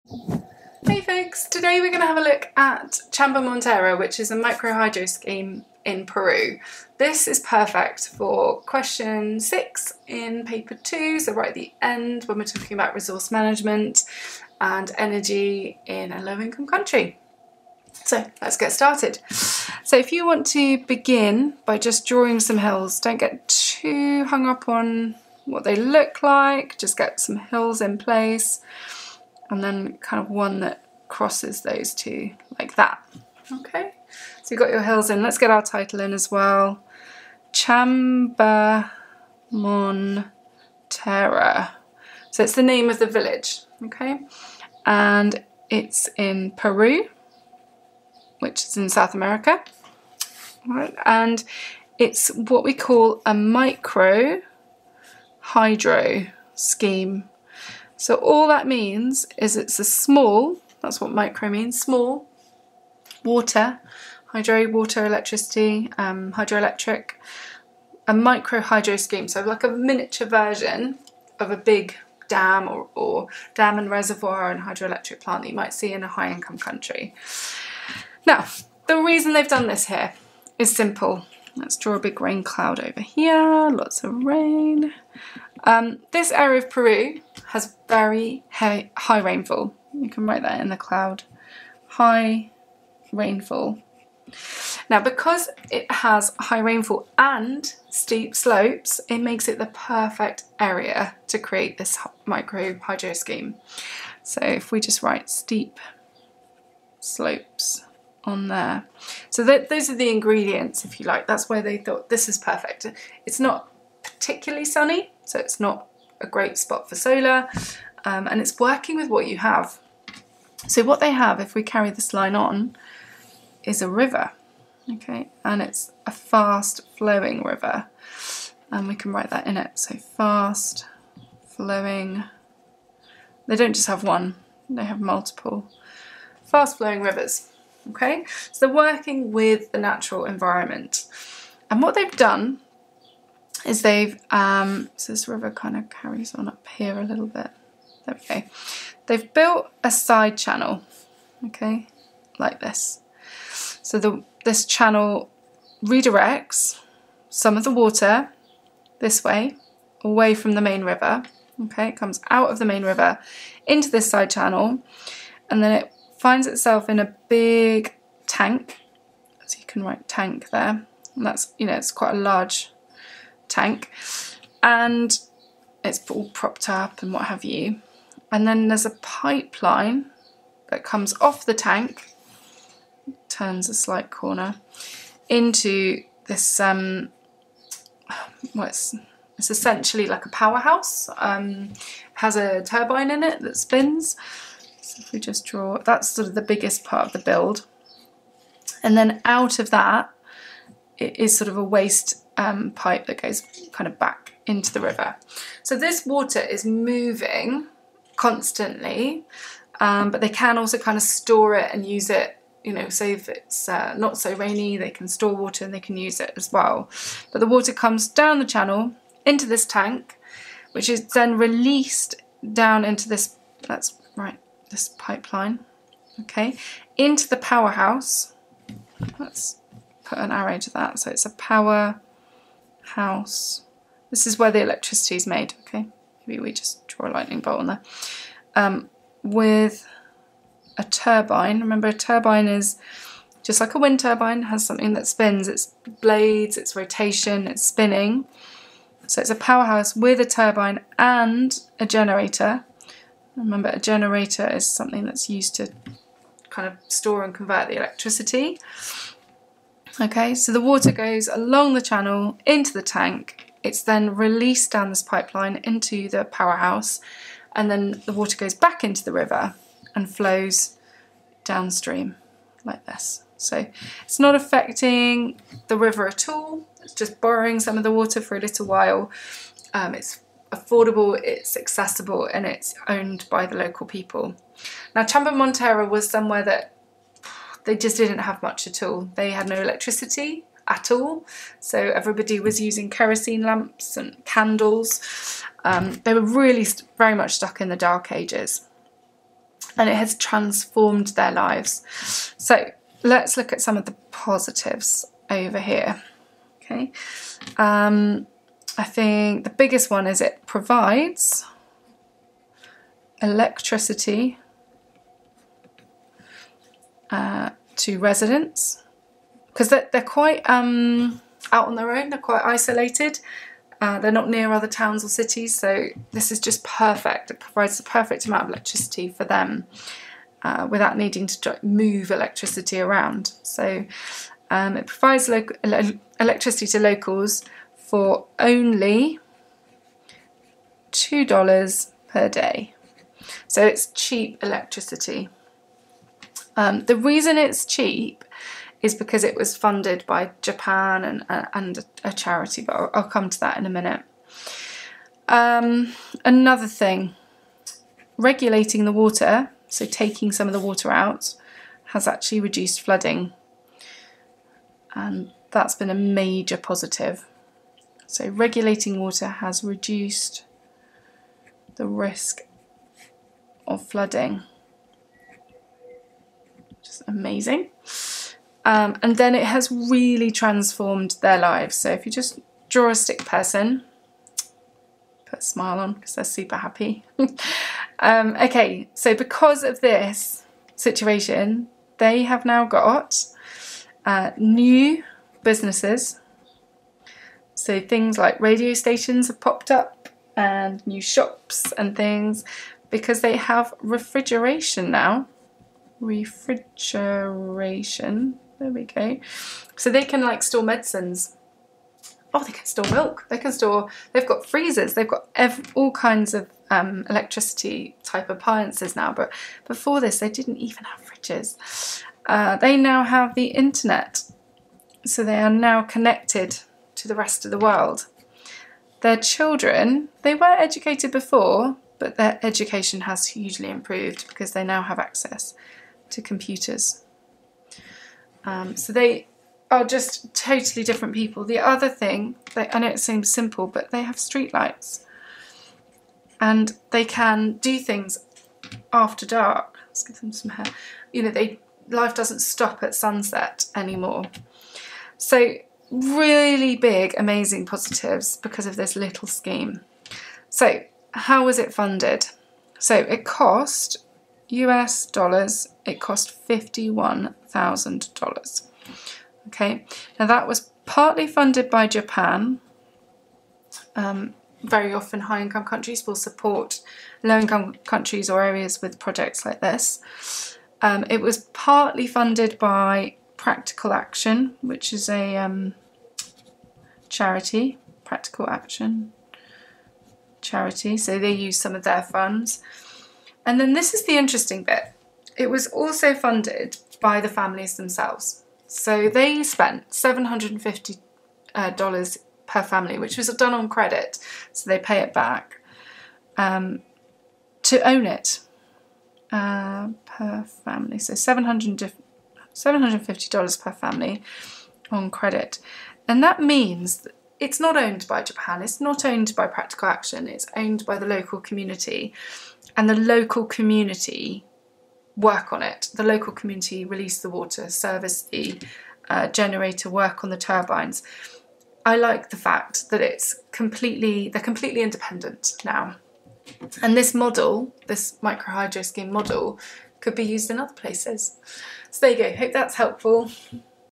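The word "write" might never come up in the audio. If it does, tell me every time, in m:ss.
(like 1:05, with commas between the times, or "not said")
1:30, 1:45, 2:09, 2:49.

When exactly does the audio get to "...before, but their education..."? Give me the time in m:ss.
7:11.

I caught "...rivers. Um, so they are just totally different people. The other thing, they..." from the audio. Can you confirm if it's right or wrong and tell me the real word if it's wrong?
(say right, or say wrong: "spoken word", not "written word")
wrong: "computers", not "rivers".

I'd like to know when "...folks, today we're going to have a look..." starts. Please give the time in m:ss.
0:00.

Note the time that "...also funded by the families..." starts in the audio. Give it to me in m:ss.
8:15.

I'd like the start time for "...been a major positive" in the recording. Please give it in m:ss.
6:05.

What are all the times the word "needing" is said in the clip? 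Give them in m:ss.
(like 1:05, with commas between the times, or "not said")
5:30.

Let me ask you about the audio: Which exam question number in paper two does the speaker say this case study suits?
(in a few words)
6.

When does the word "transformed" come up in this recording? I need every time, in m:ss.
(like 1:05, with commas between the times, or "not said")
5:00, 6:20.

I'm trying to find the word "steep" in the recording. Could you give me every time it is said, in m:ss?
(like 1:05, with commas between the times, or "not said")
1:37, 1:45.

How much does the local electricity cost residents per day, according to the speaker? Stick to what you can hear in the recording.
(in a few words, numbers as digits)
$2.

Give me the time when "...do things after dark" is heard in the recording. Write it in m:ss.
7:27.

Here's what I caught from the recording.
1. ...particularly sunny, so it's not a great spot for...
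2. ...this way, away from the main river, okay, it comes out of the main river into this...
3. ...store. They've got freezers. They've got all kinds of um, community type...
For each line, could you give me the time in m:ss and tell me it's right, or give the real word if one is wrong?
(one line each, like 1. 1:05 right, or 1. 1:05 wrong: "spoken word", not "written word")
1. 1:54 right
2. 2:38 right
3. 6:53 wrong: "electricity", not "community".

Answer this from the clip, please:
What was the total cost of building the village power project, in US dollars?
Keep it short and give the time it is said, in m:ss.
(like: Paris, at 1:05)
$51,000, at 7:46.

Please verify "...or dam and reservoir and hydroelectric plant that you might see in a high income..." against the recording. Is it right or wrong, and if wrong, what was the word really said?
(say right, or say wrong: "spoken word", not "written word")
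right.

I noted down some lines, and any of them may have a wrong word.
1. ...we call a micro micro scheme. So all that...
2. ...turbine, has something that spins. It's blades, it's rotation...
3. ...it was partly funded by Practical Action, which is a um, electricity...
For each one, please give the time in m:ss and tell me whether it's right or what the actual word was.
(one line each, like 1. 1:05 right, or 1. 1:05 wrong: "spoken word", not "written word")
1. 0:52 wrong: "hydro", not "micro"
2. 4:04 right
3. 8:01 wrong: "charity", not "electricity".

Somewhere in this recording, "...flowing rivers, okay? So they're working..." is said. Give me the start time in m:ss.
2:16.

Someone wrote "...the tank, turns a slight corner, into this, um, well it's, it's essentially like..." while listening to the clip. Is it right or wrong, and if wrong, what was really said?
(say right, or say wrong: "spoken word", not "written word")
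right.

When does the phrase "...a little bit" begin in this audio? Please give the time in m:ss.
2:26.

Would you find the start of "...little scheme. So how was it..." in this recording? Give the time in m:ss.
7:38.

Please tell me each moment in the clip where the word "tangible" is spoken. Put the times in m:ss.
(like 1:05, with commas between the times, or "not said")
not said.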